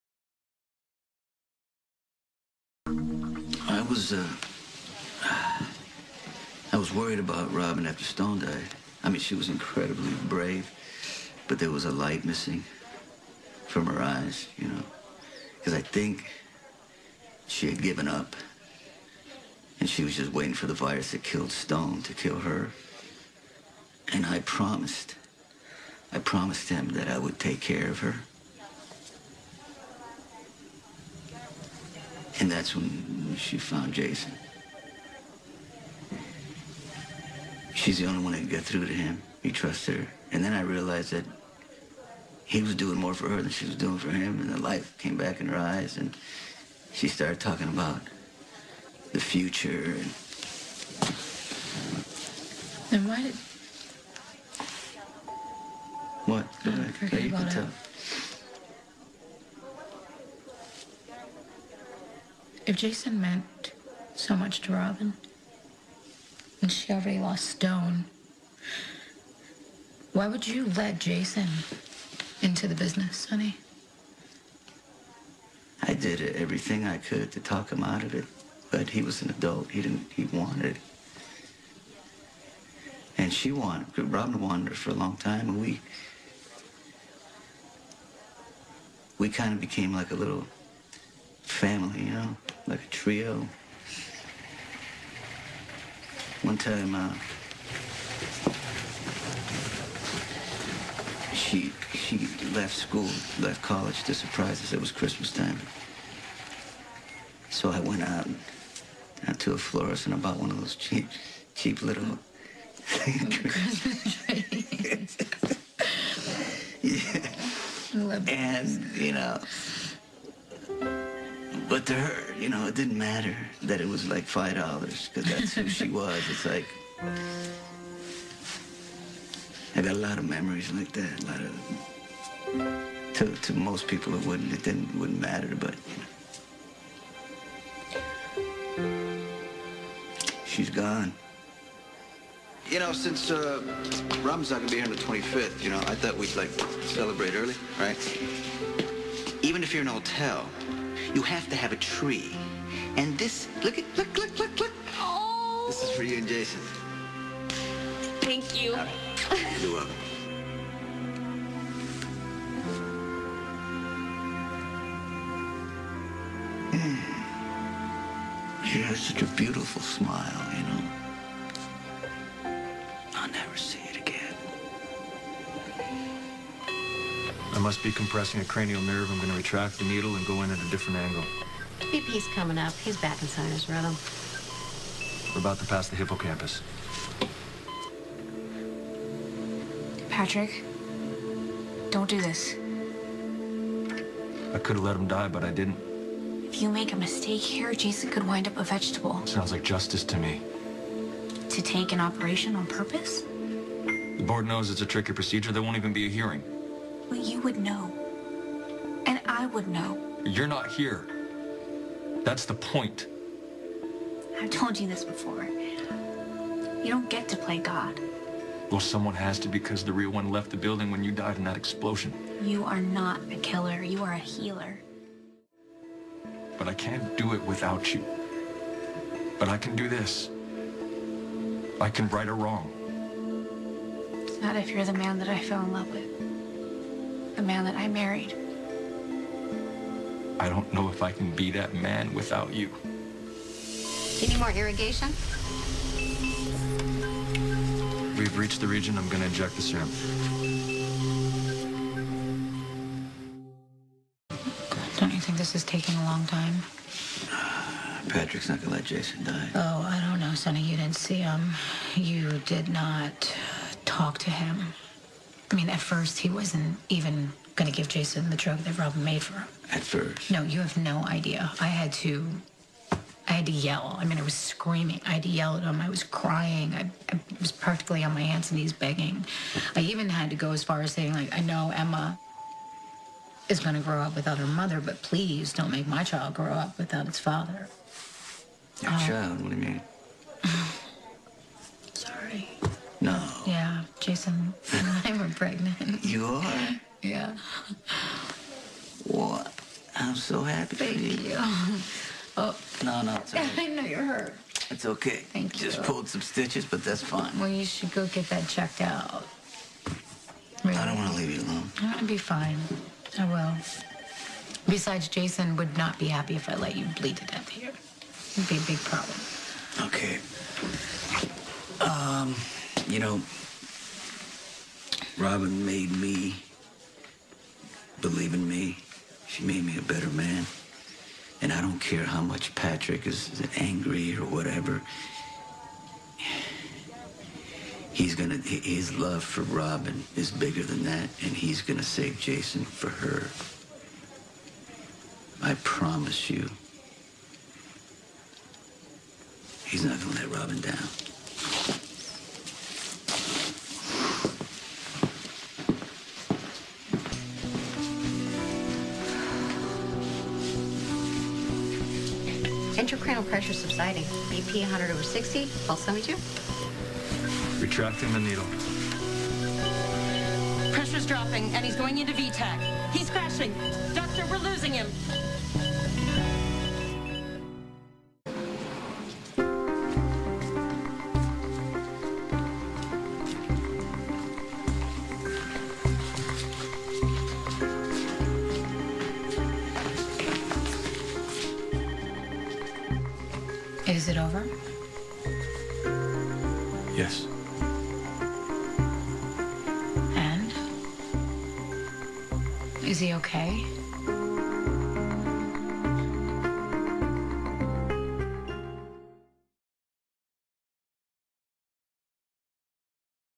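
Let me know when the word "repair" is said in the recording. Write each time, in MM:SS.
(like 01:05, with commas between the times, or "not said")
not said.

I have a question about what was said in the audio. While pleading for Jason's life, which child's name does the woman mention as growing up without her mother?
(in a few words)
Emma.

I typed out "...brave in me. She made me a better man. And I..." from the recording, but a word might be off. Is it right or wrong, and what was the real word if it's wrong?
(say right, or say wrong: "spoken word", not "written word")
wrong: "believe", not "brave".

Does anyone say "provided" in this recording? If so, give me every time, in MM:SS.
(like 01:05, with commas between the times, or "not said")
not said.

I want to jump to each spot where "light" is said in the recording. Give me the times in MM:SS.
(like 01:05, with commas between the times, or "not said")
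00:11, 00:44.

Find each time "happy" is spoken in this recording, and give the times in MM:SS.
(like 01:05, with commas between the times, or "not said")
05:00, 05:16.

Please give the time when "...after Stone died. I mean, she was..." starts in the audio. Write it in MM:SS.
00:07.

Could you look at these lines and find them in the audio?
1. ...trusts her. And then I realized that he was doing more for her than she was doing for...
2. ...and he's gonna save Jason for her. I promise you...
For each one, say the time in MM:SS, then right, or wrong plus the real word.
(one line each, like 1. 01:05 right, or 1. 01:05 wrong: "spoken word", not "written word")
1. 00:39 right
2. 05:41 right.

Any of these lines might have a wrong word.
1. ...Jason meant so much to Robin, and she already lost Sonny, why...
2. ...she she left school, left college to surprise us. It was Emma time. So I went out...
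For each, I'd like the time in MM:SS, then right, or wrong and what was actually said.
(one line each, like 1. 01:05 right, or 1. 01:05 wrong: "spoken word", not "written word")
1. 01:02 wrong: "Stone", not "Sonny"
2. 01:41 wrong: "Christmas", not "Emma".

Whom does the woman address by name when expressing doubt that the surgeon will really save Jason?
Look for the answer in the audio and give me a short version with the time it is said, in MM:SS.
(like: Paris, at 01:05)
Sonny, at 04:20.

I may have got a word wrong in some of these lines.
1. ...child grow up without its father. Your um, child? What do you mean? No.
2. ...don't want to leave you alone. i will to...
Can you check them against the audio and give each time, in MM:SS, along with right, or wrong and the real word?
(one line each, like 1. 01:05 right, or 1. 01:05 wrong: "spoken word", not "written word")
1. 04:46 right
2. 05:10 right.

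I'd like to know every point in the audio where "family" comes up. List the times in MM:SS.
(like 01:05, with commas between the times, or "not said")
01:31.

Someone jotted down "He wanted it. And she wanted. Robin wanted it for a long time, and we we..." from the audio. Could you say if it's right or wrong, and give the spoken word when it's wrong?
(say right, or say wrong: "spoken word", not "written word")
right.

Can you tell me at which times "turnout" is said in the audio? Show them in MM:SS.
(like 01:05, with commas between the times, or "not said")
not said.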